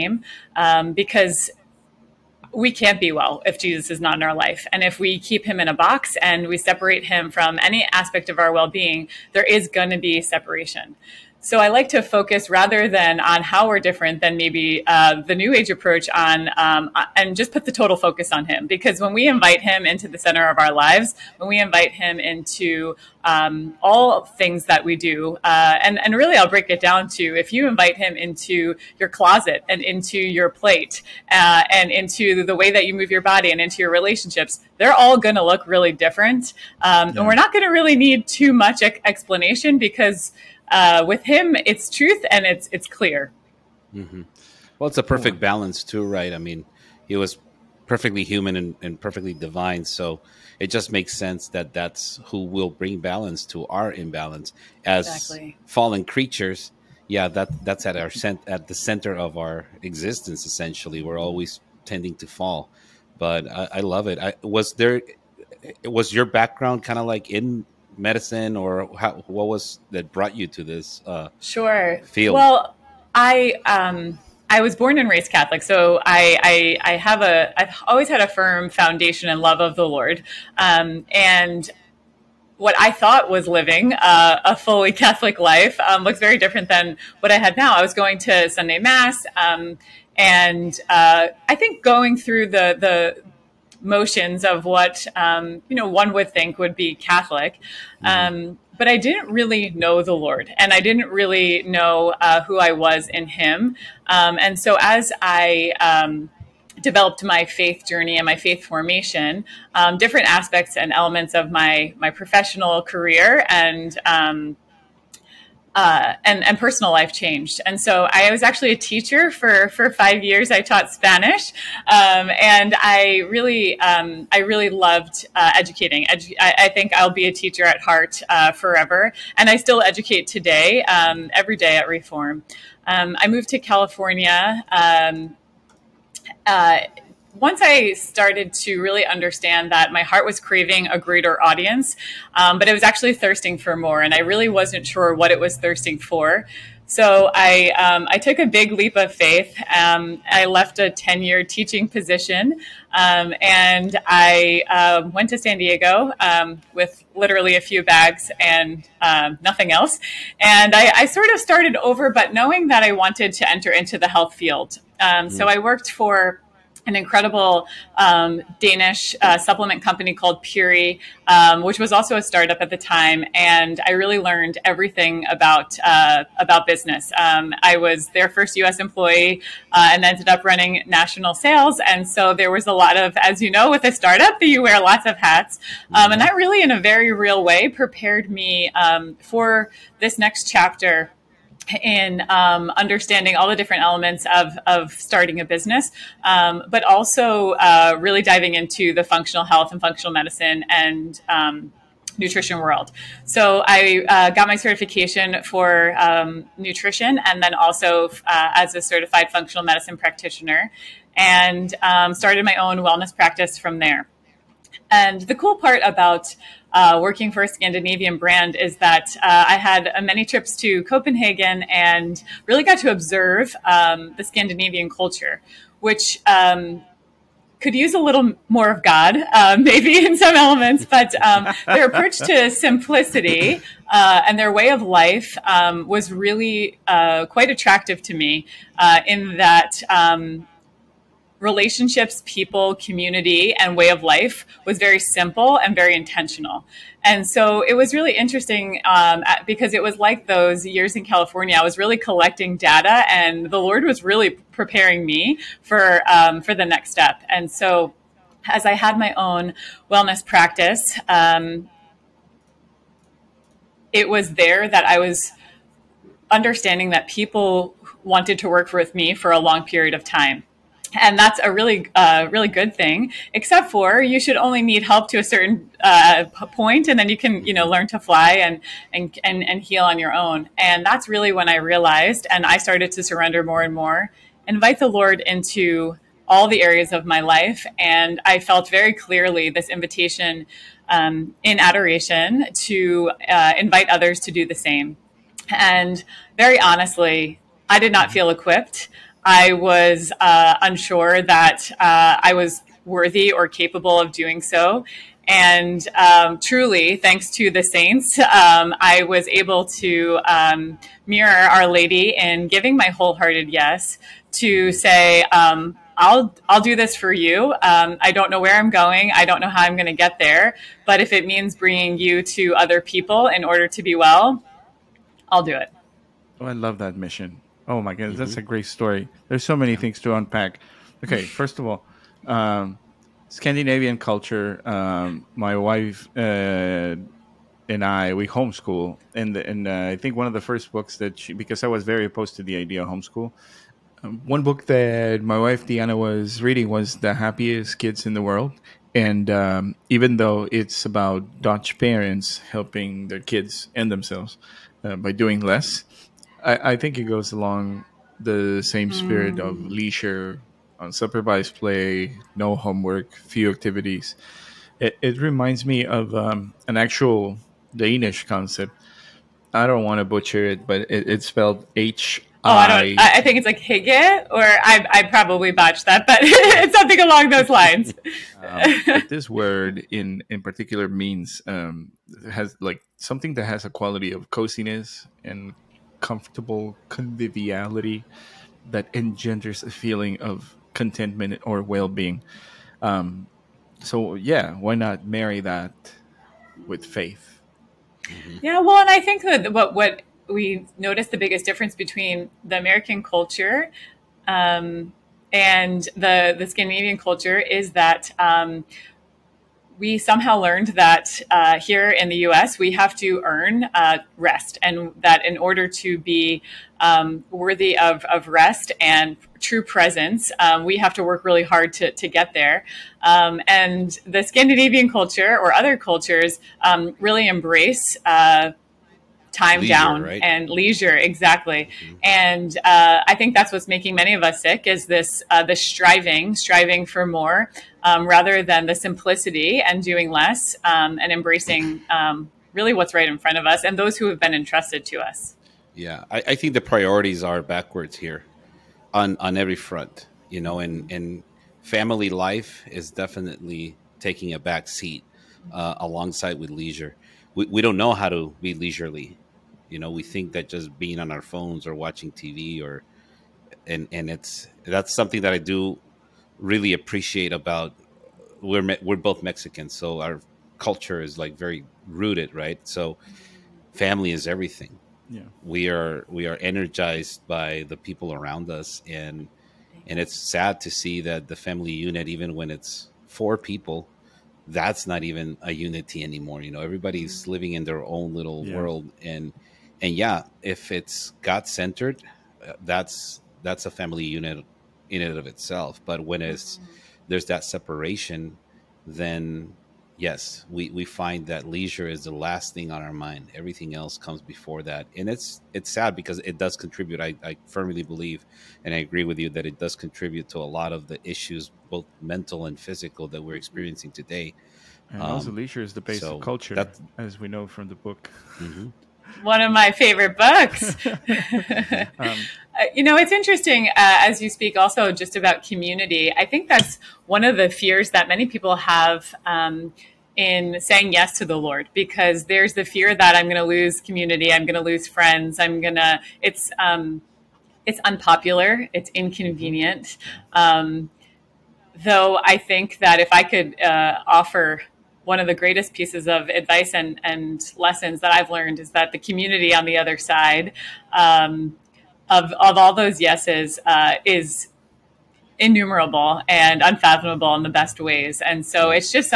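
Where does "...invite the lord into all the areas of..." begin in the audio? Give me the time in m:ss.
4:44.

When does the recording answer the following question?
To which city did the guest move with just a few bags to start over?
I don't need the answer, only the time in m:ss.
2:35.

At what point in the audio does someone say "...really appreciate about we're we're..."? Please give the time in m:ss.
7:46.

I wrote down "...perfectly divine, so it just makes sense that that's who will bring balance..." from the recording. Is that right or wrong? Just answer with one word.
right.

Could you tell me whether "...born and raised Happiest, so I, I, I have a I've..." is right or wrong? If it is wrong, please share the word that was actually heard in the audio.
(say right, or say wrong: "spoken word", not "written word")
wrong: "Catholic", not "Happiest".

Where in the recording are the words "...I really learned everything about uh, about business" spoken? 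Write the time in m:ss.
2:53.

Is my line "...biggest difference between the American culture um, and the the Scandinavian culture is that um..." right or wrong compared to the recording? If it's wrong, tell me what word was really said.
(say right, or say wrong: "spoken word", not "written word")
right.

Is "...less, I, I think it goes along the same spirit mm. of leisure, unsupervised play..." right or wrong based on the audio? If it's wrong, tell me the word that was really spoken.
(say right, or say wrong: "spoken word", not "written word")
right.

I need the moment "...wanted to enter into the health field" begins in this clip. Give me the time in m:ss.
2:42.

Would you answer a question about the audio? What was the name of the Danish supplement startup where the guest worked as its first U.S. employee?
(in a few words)
Puori.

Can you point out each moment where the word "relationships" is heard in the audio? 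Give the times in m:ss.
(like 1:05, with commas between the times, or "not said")
0:33, 4:01.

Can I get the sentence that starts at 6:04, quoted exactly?
It, it reminds me of um, an actual Danish concept.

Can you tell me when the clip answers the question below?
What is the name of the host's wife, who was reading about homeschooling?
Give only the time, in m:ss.
5:45.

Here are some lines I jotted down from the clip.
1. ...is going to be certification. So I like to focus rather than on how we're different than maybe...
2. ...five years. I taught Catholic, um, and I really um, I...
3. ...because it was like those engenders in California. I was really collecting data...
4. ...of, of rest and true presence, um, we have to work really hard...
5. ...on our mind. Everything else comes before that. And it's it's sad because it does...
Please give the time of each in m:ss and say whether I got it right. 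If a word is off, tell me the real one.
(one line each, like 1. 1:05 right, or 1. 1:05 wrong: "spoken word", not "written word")
1. 0:09 wrong: "separation", not "certification"
2. 1:59 wrong: "Spanish", not "Catholic"
3. 4:09 wrong: "years", not "engenders"
4. 6:57 right
5. 8:22 right.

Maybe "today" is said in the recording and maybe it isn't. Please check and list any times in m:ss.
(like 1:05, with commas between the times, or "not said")
2:10, 8:33.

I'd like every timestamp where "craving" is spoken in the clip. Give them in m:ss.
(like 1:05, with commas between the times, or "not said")
2:20.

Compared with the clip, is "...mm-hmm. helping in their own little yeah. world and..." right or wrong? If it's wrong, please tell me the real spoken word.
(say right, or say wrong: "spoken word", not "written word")
wrong: "living", not "helping".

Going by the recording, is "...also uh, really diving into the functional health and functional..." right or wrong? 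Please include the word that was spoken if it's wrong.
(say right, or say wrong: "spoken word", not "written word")
right.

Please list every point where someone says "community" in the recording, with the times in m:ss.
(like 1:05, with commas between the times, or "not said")
4:02, 8:45, 8:53, 9:08.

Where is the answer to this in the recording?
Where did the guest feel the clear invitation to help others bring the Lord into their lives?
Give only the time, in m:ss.
4:51.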